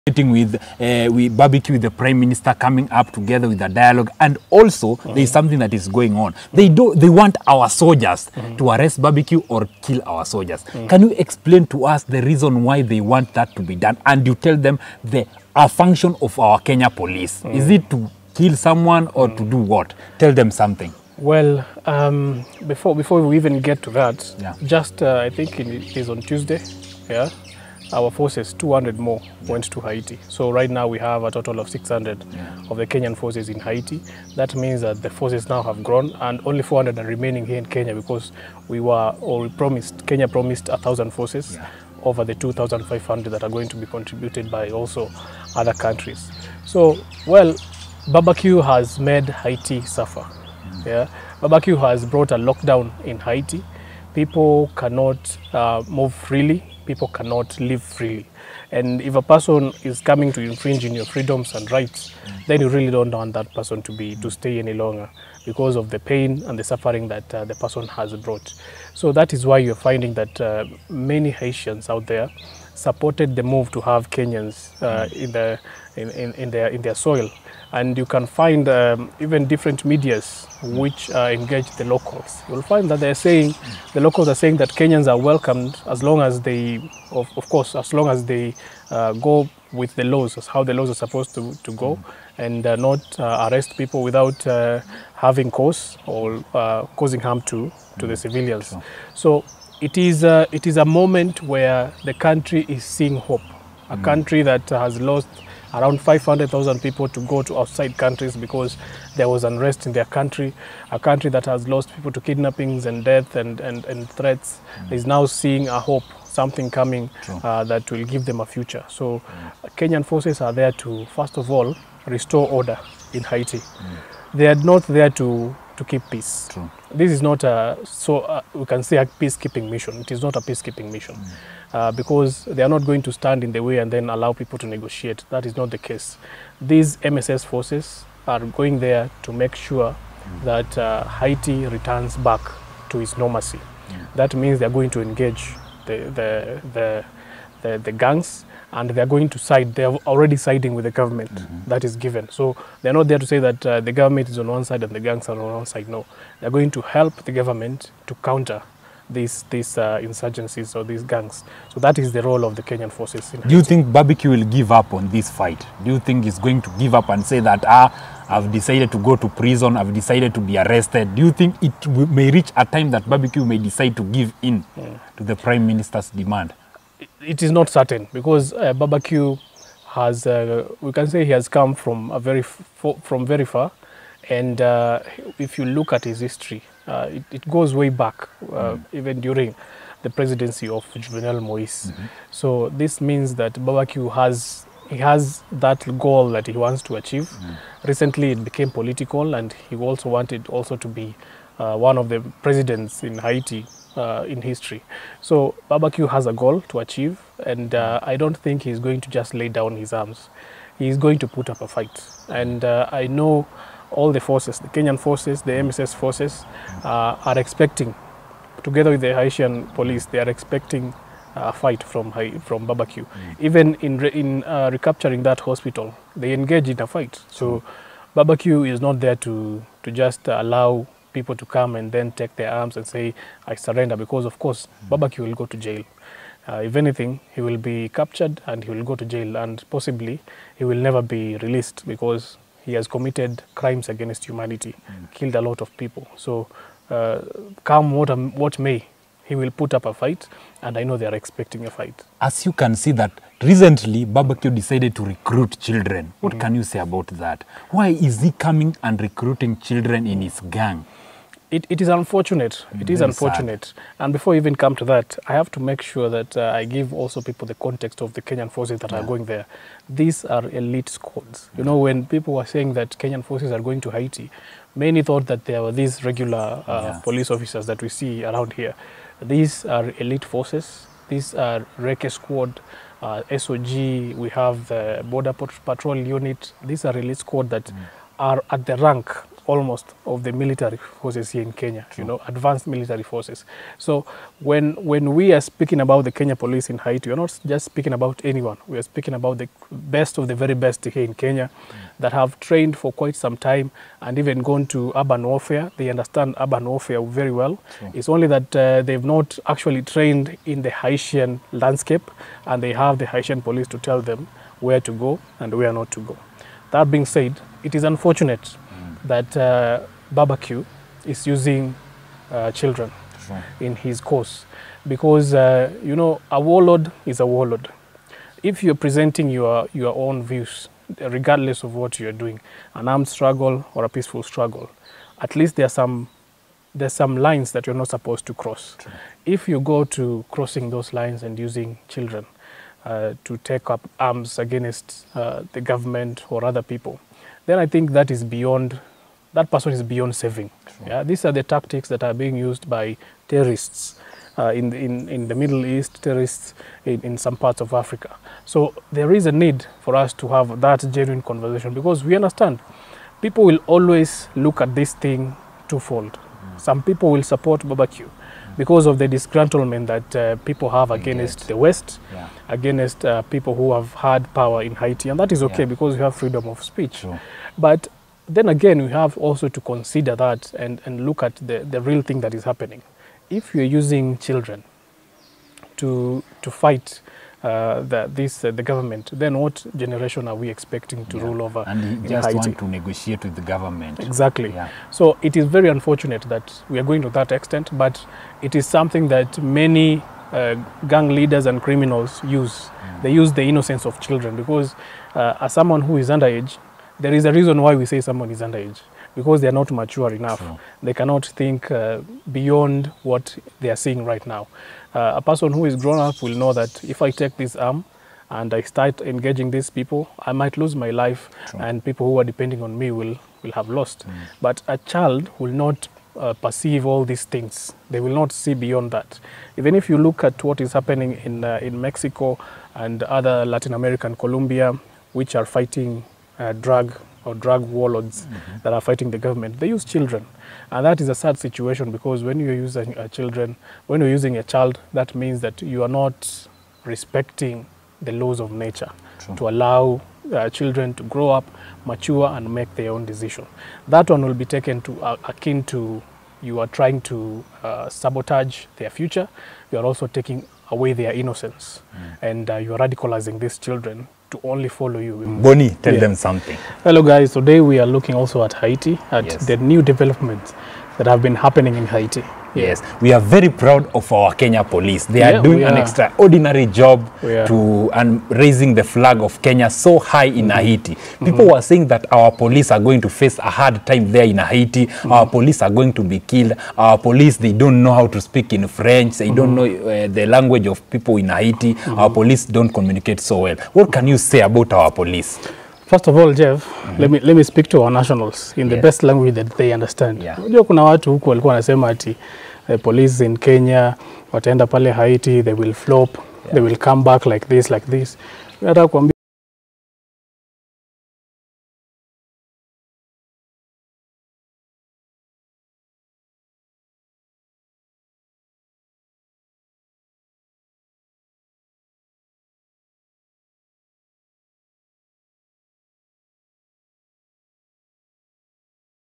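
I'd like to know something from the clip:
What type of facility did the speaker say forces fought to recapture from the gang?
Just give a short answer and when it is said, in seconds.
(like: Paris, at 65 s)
hospital, at 225 s.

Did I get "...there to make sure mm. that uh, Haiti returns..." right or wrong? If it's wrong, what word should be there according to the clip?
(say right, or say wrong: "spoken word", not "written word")
right.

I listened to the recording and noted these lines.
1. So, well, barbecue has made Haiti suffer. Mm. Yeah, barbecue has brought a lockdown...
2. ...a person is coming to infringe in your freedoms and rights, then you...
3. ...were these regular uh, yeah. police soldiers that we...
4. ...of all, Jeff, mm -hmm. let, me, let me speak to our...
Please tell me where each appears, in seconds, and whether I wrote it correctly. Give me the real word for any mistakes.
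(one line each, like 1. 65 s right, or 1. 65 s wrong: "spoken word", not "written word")
1. 46 s right
2. 59 s right
3. 275 s wrong: "officers", not "soldiers"
4. 496 s right.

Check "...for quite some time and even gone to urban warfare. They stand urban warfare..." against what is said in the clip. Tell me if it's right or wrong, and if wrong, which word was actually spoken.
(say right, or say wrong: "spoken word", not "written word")
wrong: "understand", not "stand".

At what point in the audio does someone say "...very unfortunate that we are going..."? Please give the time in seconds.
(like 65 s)
395 s.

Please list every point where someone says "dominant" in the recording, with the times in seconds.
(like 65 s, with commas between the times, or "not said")
not said.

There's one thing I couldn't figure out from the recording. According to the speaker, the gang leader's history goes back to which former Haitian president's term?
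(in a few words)
Jovenel Moise.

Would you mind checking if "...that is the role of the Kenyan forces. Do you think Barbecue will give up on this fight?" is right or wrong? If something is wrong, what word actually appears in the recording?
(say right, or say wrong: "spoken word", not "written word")
right.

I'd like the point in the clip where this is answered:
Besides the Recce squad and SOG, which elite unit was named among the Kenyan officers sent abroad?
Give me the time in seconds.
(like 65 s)
285 s.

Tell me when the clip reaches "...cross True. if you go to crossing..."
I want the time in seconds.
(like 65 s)
338 s.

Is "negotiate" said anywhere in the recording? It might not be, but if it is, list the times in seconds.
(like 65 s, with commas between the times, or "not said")
134 s, 392 s.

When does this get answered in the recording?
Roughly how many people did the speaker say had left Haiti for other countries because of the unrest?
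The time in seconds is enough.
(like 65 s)
106 s.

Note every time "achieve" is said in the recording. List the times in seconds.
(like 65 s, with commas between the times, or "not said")
196 s, 206 s.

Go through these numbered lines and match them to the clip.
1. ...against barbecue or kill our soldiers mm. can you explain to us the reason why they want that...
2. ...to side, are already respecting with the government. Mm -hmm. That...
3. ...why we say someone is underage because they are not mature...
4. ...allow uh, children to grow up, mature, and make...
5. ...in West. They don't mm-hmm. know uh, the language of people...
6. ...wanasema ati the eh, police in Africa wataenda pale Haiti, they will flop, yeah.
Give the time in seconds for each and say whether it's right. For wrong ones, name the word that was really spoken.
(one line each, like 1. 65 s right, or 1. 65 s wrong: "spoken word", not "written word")
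1. 8 s wrong: "arrest", not "against"
2. 149 s wrong: "siding", not "respecting"
3. 407 s right
4. 449 s right
5. 488 s wrong: "French", not "West"
6. 501 s wrong: "Kenya", not "Africa".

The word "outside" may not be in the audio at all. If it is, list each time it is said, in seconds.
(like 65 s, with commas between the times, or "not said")
107 s.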